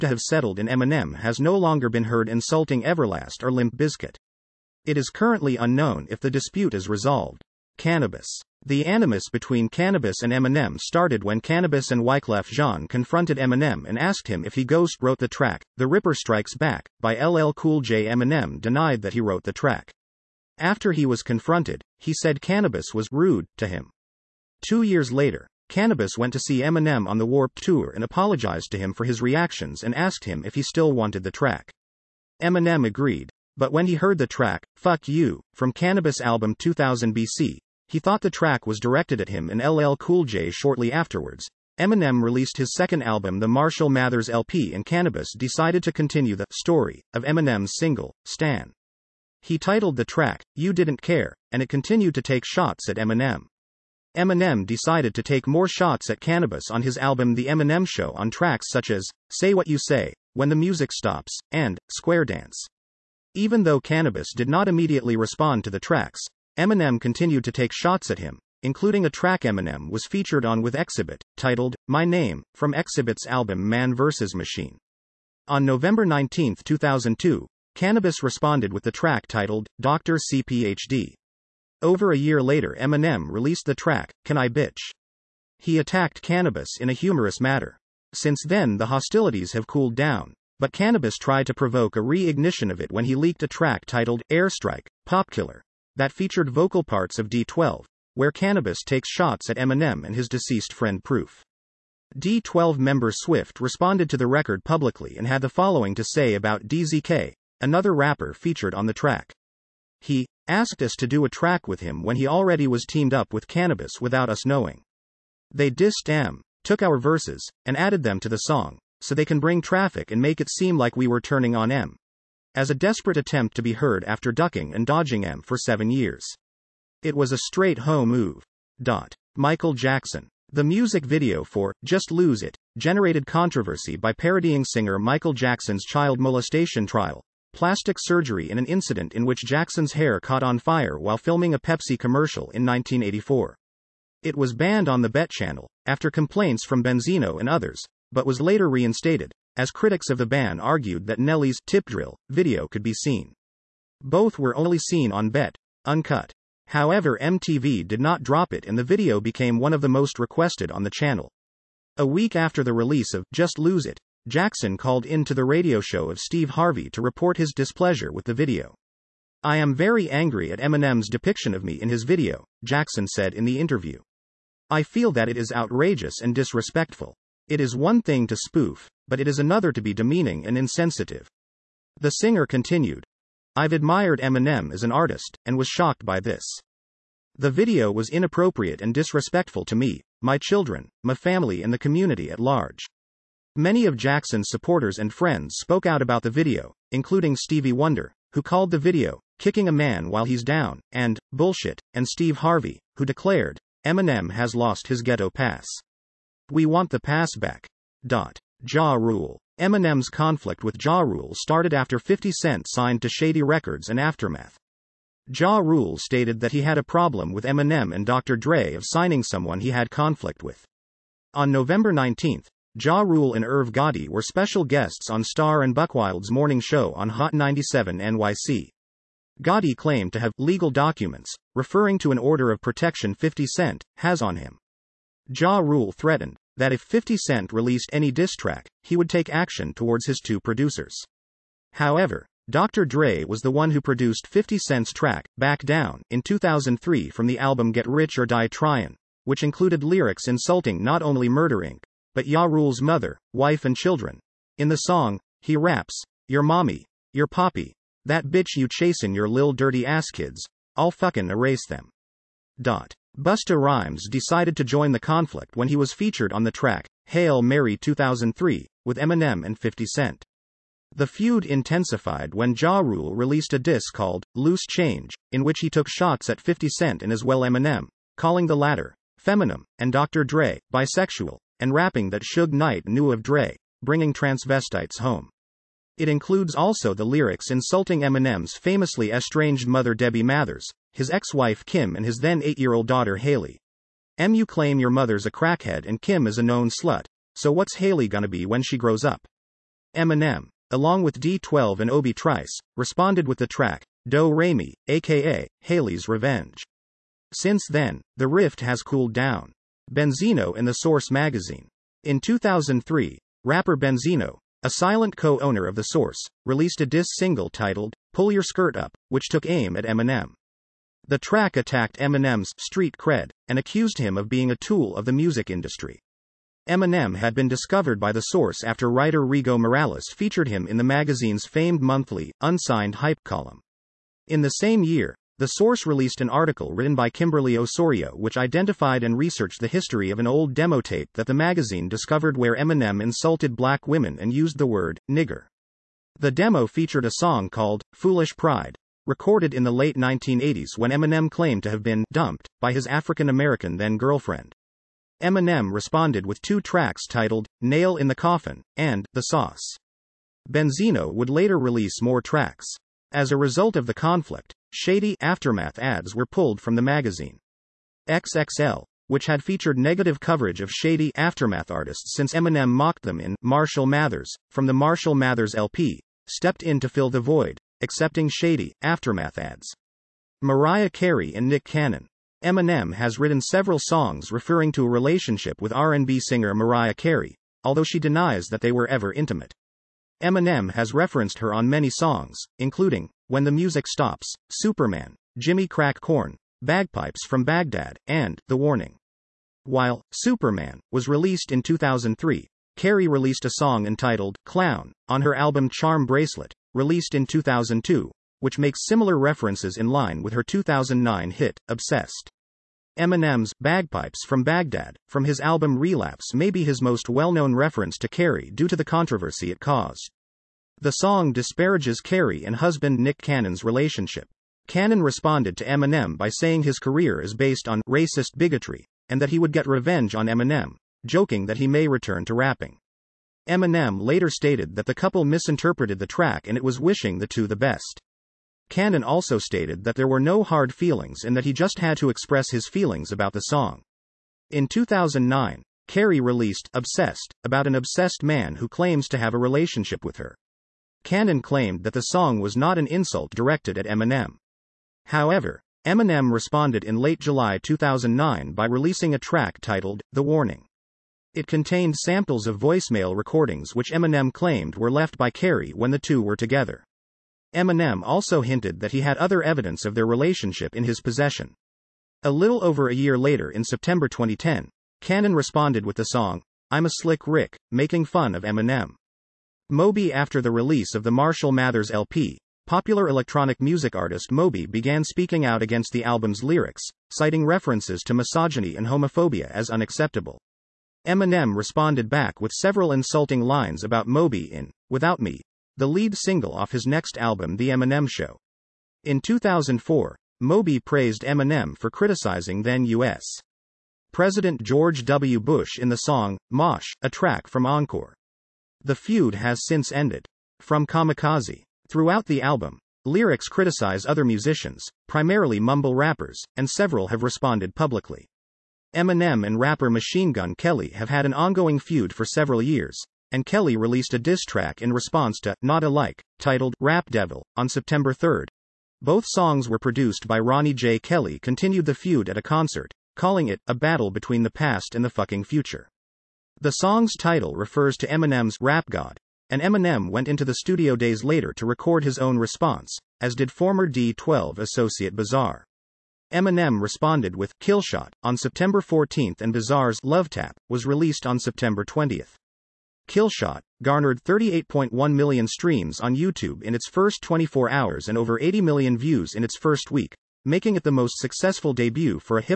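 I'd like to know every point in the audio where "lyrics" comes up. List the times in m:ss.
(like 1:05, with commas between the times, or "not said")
4:09, 4:47, 8:06, 8:33.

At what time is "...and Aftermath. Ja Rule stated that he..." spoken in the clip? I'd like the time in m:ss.
3:33.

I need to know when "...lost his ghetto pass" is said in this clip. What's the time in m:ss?
3:24.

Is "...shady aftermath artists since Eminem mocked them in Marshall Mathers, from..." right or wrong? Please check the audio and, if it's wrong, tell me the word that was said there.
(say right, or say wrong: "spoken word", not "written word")
right.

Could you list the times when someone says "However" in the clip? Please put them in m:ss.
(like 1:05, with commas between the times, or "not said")
2:36, 4:01, 7:35.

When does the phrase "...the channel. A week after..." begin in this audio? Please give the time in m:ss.
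2:40.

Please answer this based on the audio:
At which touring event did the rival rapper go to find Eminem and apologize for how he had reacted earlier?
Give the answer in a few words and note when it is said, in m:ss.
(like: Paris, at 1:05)
Warped Tour, at 0:27.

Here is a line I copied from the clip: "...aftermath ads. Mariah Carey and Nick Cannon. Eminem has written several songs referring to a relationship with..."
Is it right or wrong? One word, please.
right.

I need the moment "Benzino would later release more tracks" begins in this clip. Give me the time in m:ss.
6:00.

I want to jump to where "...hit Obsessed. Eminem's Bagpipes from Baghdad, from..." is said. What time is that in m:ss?
6:51.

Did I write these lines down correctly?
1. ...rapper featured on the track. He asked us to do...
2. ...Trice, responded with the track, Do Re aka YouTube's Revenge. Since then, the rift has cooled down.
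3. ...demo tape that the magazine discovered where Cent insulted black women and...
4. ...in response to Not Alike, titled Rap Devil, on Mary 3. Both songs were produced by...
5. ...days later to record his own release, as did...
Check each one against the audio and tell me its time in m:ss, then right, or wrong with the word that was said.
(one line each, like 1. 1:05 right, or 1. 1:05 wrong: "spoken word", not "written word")
1. 1:47 right
2. 5:02 wrong: "Haley", not "YouTube"
3. 5:40 wrong: "Eminem", not "Cent"
4. 8:44 wrong: "September", not "Mary"
5. 9:00 wrong: "response", not "release".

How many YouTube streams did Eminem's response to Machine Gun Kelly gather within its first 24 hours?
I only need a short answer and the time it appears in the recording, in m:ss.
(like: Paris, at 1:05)
38.1 million, at 9:14.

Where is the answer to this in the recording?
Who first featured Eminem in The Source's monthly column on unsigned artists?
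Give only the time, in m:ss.
5:29.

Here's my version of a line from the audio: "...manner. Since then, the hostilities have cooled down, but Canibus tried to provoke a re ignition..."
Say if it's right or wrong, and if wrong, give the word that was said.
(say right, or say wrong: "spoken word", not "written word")
right.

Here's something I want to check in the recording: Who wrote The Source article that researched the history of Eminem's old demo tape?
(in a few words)
Kimberly Osorio.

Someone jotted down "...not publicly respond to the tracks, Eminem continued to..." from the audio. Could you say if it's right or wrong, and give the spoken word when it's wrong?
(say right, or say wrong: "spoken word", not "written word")
wrong: "immediately", not "publicly".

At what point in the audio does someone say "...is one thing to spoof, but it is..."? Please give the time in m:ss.
2:57.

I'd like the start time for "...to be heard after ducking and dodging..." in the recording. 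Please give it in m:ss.
2:03.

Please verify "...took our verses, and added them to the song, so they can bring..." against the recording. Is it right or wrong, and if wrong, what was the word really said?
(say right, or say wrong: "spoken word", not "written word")
right.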